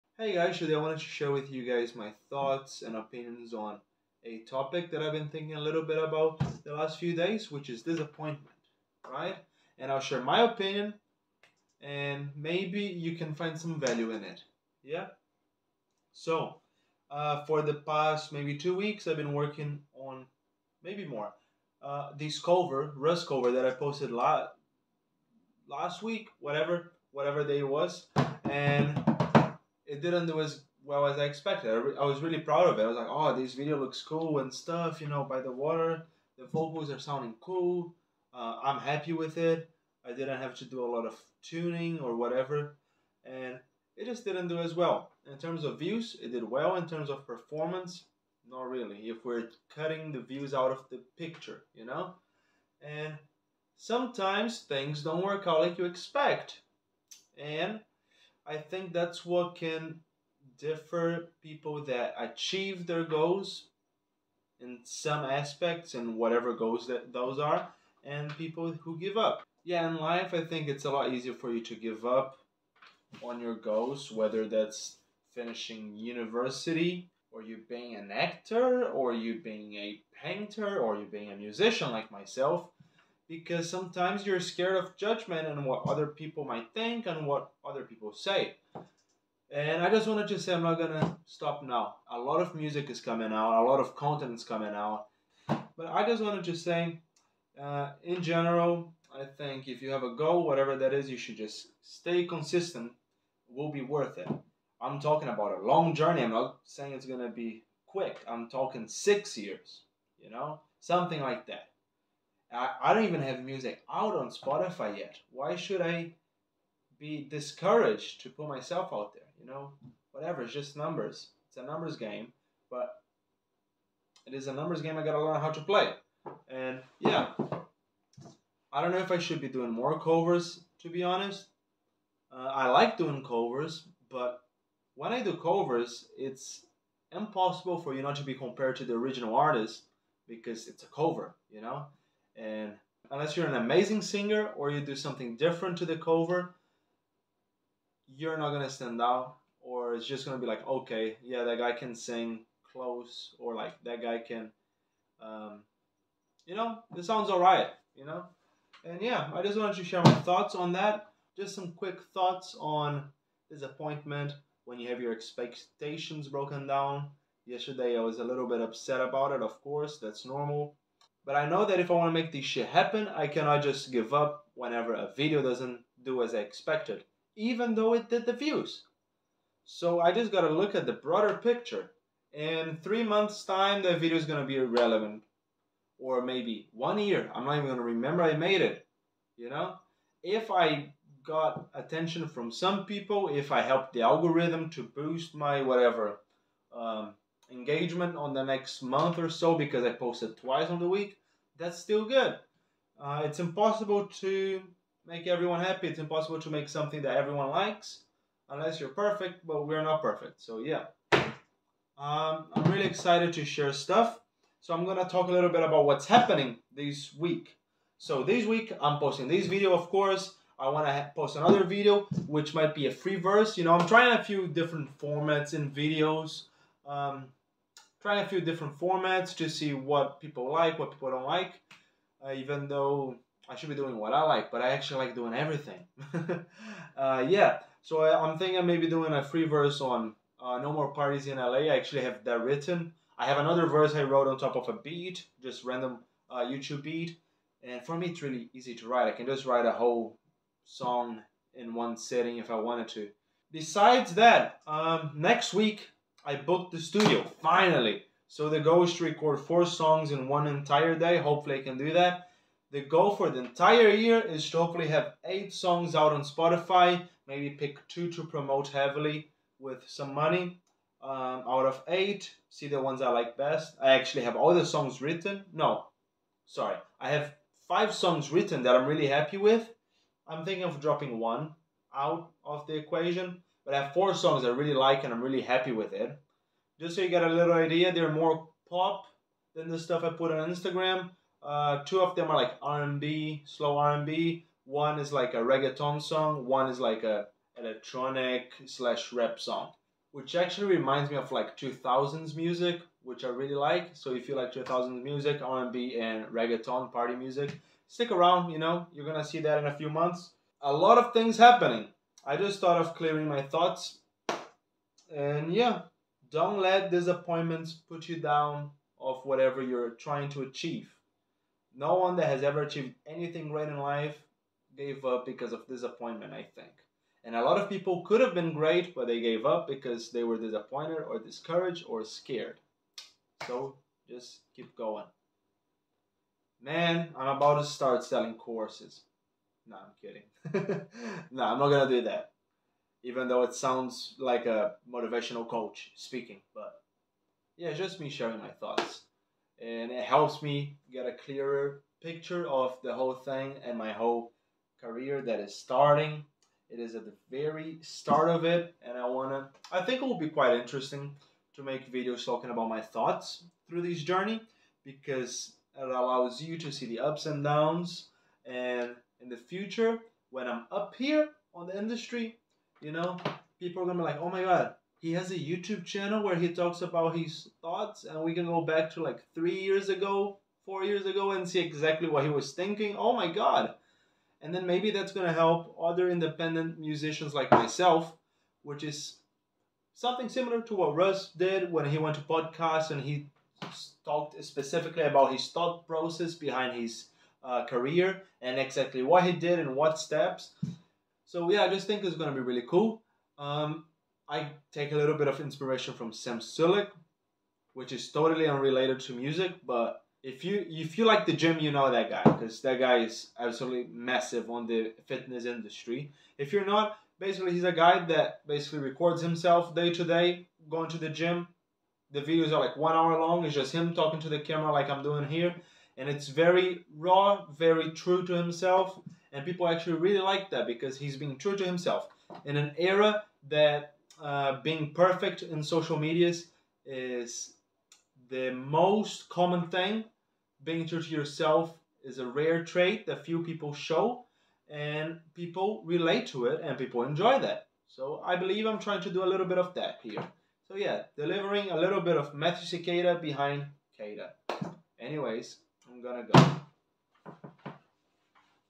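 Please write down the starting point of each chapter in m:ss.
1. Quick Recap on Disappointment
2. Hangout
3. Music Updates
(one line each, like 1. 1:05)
1. 5:10
2. 6:00
3. 3:30.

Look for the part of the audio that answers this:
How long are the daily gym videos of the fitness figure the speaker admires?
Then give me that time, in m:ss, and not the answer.
7:02.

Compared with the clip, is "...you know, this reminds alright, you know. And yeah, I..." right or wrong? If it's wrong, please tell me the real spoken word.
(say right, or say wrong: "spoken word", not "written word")
wrong: "sounds", not "reminds".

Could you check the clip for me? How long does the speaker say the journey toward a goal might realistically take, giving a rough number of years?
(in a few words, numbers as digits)
6 years.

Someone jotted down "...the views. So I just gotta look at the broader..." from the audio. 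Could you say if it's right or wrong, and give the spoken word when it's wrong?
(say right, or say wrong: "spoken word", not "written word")
right.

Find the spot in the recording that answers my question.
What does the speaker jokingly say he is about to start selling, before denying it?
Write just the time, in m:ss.
5:38.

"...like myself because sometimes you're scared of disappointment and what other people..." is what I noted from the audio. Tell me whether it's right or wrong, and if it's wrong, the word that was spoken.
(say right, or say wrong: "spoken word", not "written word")
wrong: "judgment", not "disappointment".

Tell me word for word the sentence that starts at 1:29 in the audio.
And I just wanted to say I'm not gonna stop now.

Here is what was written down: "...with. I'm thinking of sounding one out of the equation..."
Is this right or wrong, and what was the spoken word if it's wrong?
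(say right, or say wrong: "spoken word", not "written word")
wrong: "dropping", not "sounding".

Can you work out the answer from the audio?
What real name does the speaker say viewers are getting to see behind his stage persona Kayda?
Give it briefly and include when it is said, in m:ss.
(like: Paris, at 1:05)
Matthew Siqueira, at 7:32.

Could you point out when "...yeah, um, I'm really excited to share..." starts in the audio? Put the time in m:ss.
3:30.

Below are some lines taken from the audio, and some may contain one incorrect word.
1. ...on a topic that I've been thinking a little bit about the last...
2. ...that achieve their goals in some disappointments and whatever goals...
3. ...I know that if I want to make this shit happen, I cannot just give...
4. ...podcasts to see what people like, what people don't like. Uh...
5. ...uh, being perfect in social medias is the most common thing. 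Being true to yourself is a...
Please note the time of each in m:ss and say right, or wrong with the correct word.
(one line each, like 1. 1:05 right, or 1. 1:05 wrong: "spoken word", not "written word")
1. 0:03 right
2. 1:01 wrong: "aspects", not "disappointments"
3. 2:51 right
4. 3:48 wrong: "formats", not "podcasts"
5. 7:14 right.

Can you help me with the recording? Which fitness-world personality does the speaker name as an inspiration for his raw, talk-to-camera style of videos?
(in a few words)
Sam Sulek.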